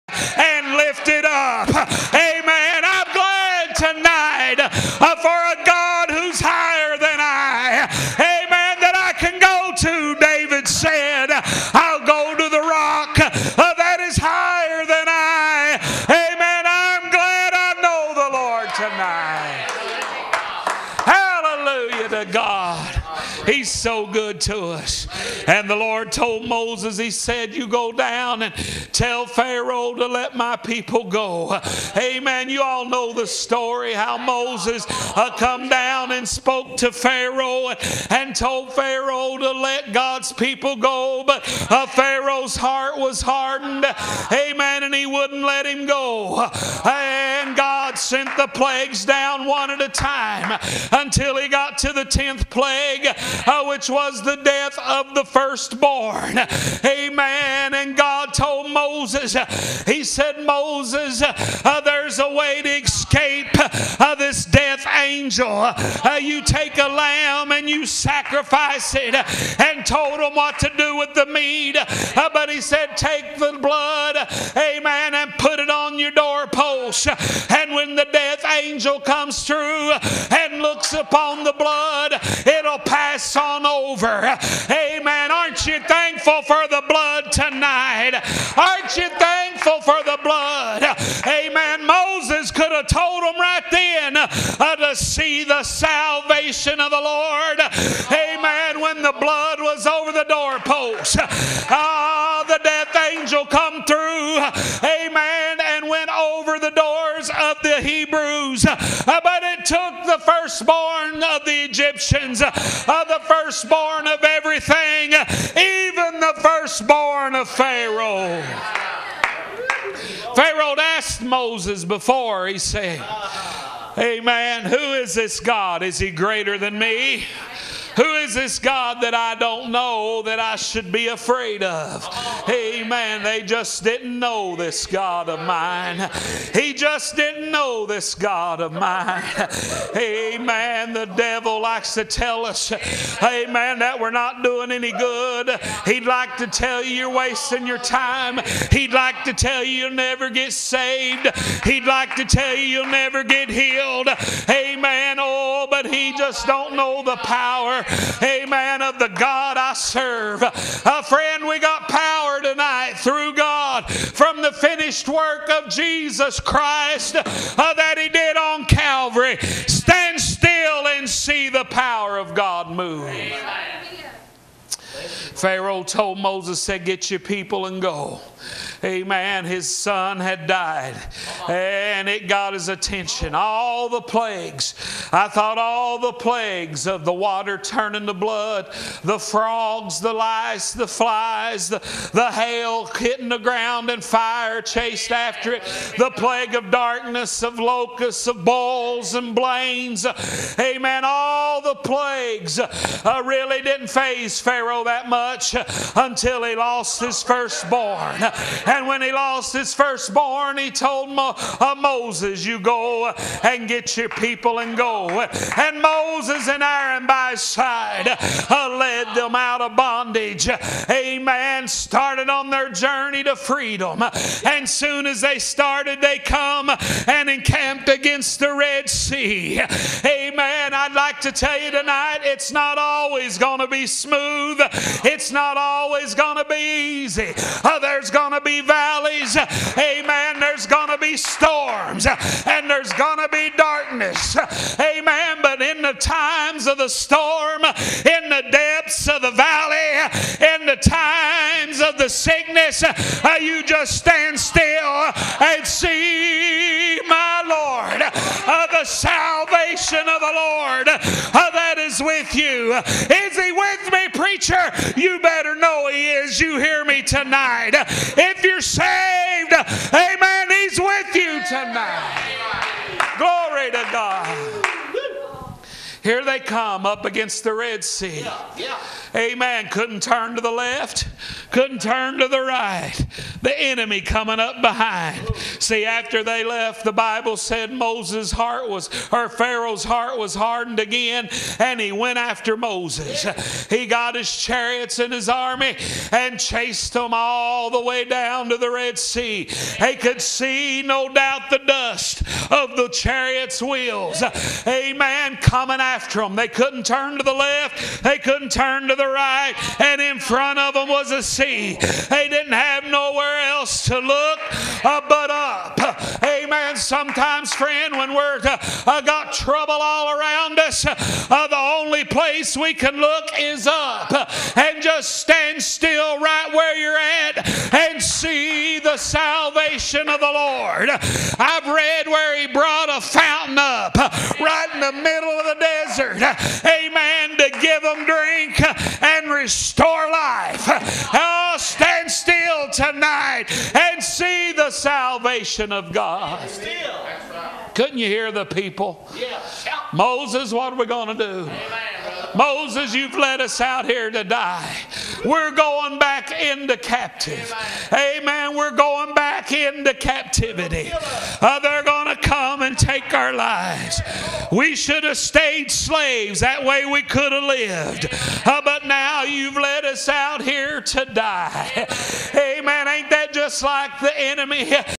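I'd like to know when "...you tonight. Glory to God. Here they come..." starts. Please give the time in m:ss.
4:31.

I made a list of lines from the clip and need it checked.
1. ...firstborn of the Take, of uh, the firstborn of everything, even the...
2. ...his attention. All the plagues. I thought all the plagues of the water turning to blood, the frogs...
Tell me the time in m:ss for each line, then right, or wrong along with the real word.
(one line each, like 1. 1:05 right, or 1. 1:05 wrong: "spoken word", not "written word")
1. 1:50 wrong: "Egyptians", not "Take"
2. 3:02 right.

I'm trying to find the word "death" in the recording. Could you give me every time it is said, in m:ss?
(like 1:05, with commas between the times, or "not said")
0:54, 1:04, 1:18, 1:42.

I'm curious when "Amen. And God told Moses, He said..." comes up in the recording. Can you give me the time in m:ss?
0:56.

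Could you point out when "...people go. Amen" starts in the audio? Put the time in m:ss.
0:30.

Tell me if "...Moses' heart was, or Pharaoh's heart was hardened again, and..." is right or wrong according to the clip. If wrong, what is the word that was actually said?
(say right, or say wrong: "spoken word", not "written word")
right.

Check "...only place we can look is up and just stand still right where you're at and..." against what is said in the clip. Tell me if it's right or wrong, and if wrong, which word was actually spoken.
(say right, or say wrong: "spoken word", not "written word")
right.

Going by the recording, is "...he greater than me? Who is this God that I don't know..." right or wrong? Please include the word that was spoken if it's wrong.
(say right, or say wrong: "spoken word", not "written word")
right.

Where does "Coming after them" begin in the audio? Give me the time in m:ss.
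5:05.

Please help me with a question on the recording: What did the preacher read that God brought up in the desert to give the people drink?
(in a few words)
a fountain.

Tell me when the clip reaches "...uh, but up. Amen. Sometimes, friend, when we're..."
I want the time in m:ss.
5:14.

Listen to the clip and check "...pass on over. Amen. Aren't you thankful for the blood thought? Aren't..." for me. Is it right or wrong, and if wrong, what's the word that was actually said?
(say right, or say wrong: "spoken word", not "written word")
wrong: "tonight", not "thought".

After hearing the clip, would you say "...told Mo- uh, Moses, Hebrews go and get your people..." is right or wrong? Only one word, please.
wrong.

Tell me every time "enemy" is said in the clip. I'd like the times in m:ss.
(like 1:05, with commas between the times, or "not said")
4:43, 6:14.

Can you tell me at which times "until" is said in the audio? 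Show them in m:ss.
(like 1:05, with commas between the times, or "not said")
0:50, 3:25.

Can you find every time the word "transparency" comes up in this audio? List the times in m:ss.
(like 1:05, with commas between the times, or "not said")
not said.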